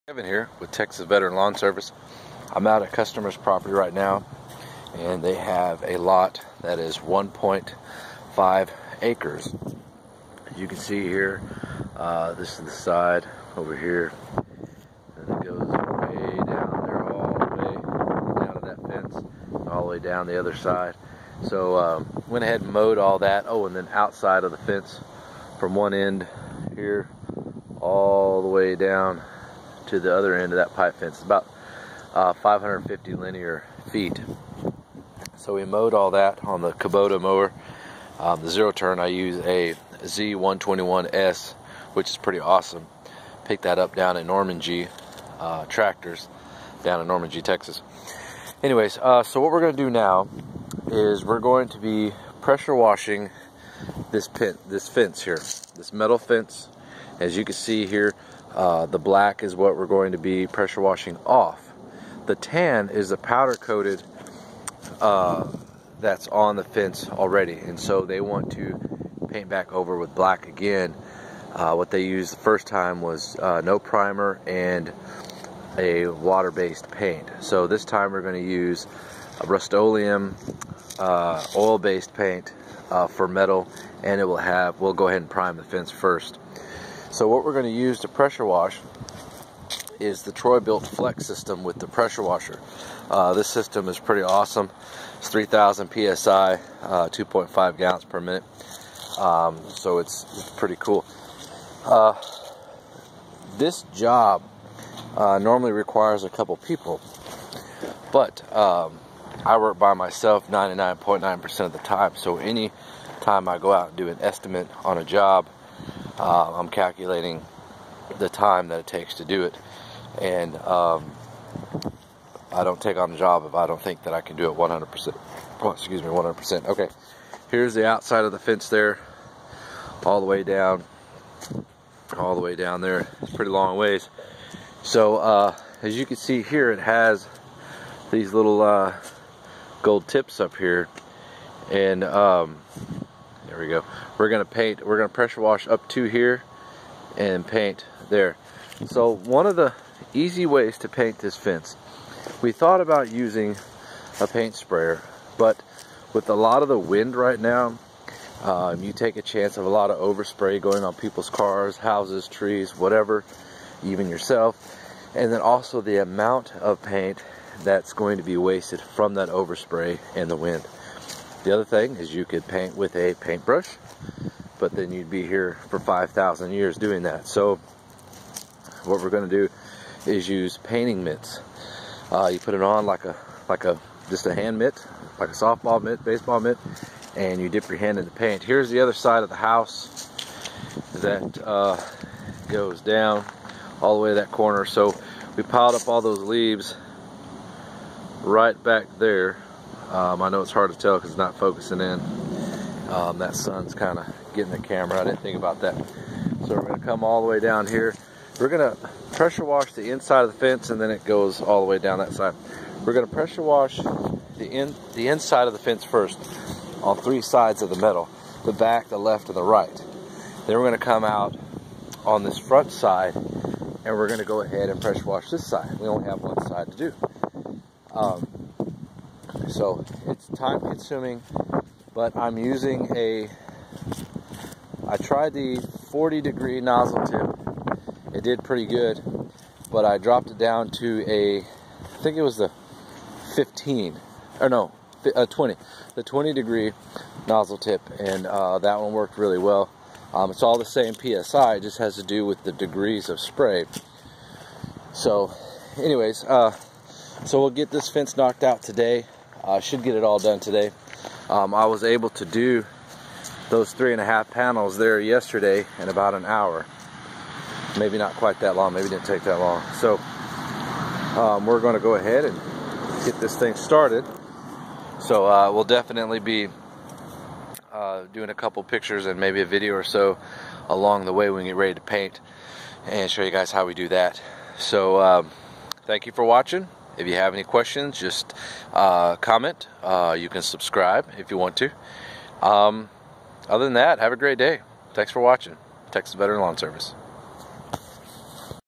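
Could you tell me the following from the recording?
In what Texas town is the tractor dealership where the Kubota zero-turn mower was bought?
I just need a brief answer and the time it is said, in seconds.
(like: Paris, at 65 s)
Normandy, Texas, at 47 s.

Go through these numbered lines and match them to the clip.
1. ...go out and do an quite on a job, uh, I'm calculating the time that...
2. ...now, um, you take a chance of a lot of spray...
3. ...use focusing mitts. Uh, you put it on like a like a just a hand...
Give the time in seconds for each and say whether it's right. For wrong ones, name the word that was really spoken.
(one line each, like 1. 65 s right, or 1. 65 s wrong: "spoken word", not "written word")
1. 113 s wrong: "estimate", not "quite"
2. 157 s wrong: "overspray", not "spray"
3. 180 s wrong: "painting", not "focusing".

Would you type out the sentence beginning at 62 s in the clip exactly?
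The tan is the powder coated uh, that's on the fence already.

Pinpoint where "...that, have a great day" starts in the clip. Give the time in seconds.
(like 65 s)
293 s.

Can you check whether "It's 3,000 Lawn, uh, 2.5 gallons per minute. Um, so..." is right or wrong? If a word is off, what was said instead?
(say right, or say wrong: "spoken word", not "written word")
wrong: "PSI", not "Lawn".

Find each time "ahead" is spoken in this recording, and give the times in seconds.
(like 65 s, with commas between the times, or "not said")
22 s, 85 s, 224 s, 271 s.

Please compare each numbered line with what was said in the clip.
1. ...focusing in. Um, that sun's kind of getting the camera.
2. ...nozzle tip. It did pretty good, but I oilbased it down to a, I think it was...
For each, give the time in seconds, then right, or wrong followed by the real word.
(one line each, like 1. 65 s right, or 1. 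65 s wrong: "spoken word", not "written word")
1. 201 s right
2. 236 s wrong: "dropped", not "oilbased".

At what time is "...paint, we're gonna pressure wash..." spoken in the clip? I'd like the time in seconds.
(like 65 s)
144 s.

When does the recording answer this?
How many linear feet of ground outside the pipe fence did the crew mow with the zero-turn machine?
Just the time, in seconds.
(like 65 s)
32 s.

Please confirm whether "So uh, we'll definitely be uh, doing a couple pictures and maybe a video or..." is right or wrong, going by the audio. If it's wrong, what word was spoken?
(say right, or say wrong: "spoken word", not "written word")
right.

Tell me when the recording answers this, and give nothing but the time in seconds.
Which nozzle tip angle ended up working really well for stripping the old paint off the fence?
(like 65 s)
246 s.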